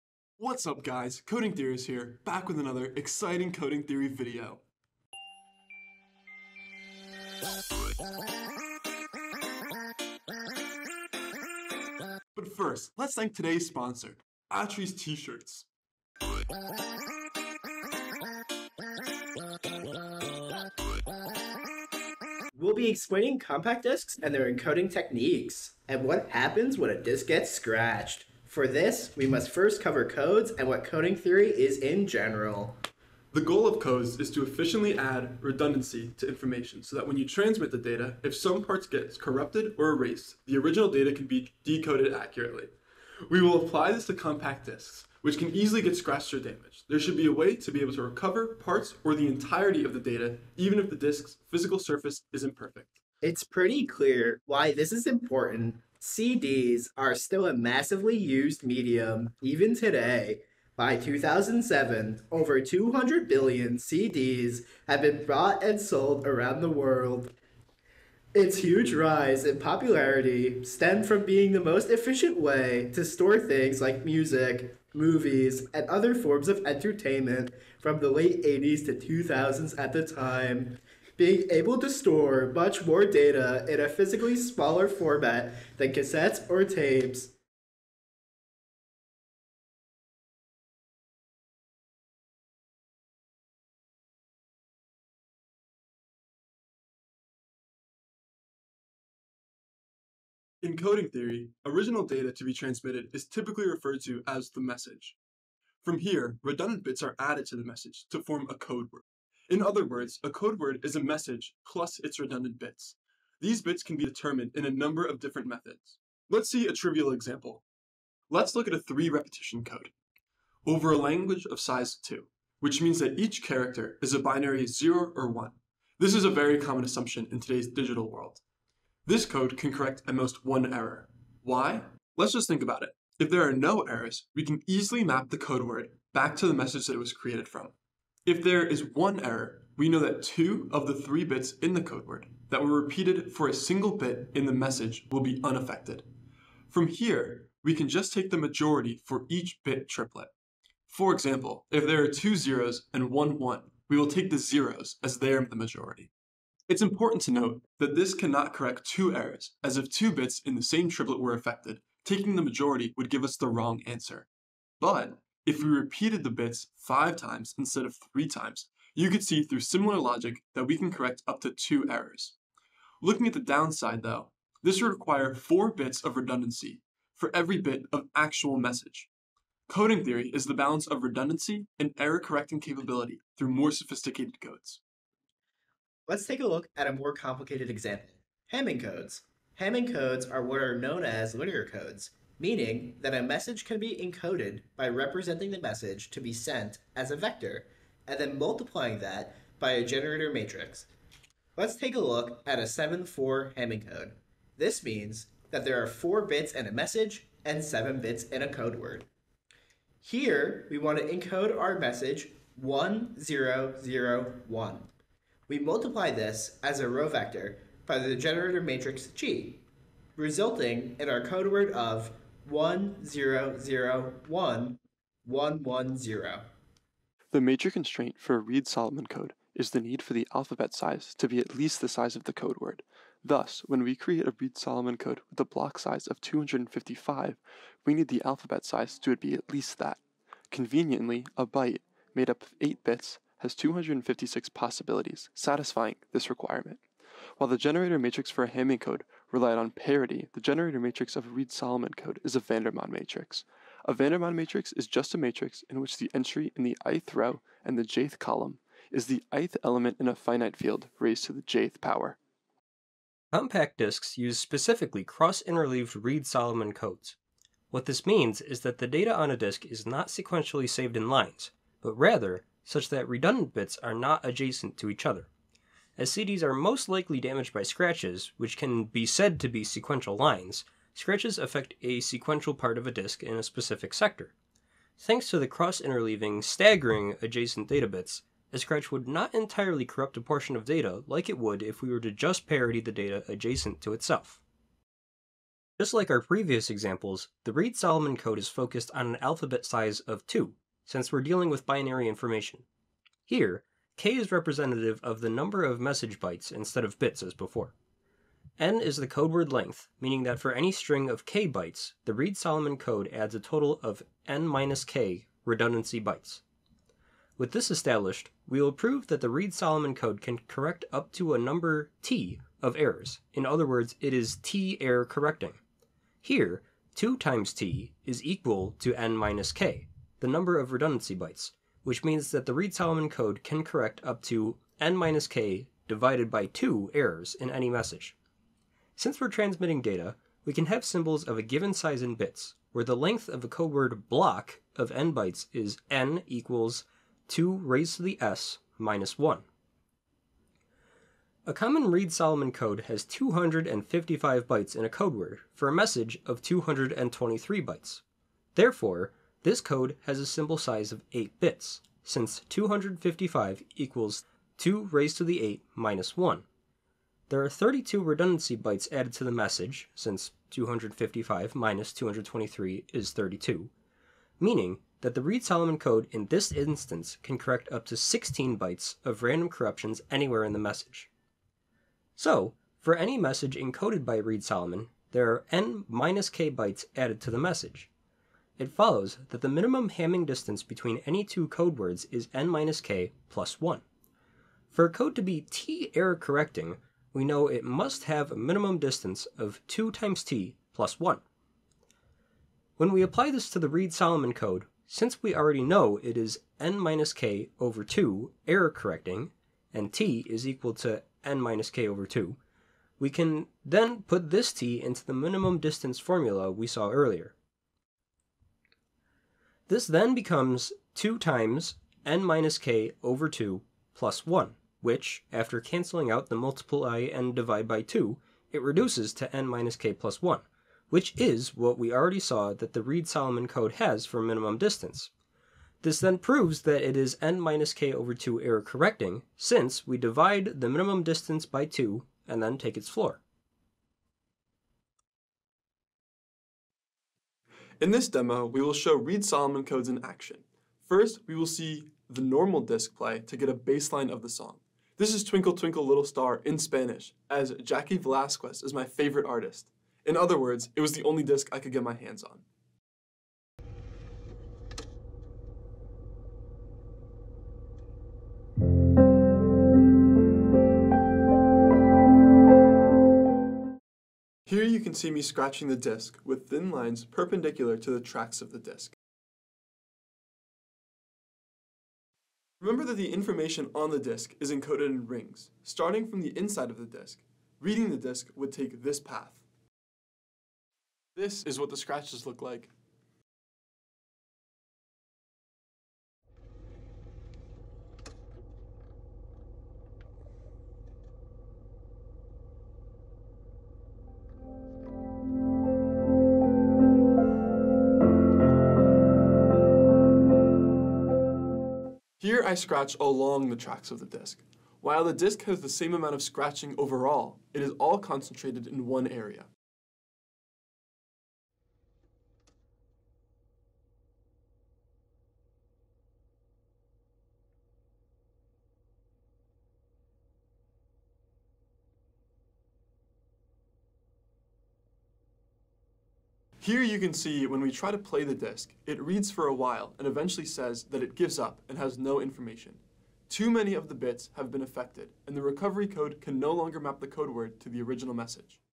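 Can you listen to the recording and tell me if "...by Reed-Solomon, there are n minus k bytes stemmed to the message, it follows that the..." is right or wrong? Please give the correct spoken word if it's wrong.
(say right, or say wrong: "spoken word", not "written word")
wrong: "added", not "stemmed".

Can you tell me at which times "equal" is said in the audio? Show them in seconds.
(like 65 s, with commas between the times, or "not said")
328 s, 346 s, 363 s, 410 s.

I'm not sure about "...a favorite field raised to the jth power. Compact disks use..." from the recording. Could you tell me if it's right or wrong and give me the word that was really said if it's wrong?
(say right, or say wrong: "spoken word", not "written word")
wrong: "finite", not "favorite".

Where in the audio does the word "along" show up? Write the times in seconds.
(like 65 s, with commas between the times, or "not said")
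512 s.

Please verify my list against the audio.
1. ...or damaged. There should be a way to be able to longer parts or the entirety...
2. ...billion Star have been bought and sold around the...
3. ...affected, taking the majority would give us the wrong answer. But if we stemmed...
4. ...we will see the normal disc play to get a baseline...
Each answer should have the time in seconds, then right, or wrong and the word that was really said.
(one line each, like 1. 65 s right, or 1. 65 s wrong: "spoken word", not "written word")
1. 46 s wrong: "recover", not "longer"
2. 63 s wrong: "CDs", not "Star"
3. 161 s wrong: "repeated", not "stemmed"
4. 451 s right.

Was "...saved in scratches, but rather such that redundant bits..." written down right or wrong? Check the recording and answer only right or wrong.
wrong.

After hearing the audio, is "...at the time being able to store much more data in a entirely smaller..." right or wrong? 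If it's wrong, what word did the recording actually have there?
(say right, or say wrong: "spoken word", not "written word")
wrong: "physically", not "entirely".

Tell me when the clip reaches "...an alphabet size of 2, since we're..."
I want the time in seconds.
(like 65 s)
299 s.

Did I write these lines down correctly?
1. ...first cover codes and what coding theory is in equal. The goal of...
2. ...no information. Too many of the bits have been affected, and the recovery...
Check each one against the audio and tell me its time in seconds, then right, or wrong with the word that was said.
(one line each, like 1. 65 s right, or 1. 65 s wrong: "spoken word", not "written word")
1. 29 s wrong: "general", not "equal"
2. 541 s right.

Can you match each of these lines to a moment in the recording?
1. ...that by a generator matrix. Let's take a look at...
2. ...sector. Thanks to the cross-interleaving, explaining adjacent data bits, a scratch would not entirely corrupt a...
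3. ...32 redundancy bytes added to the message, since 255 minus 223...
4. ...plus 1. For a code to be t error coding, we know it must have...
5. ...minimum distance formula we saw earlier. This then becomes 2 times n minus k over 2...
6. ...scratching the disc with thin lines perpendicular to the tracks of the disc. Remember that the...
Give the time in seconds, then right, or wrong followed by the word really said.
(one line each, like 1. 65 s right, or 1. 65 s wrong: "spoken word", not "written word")
1. 198 s right
2. 283 s wrong: "staggering", not "explaining"
3. 367 s right
4. 393 s wrong: "correcting", not "coding"
5. 415 s right
6. 475 s right.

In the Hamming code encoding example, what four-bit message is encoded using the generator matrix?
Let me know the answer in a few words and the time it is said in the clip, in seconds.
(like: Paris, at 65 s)
1001, at 212 s.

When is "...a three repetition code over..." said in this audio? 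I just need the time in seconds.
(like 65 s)
118 s.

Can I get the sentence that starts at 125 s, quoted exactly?
This is a very common assumption in today's digital world.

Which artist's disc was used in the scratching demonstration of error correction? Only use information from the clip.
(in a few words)
Jaci Velasquez.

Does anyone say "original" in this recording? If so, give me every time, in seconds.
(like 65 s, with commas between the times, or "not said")
40 s, 101 s, 547 s.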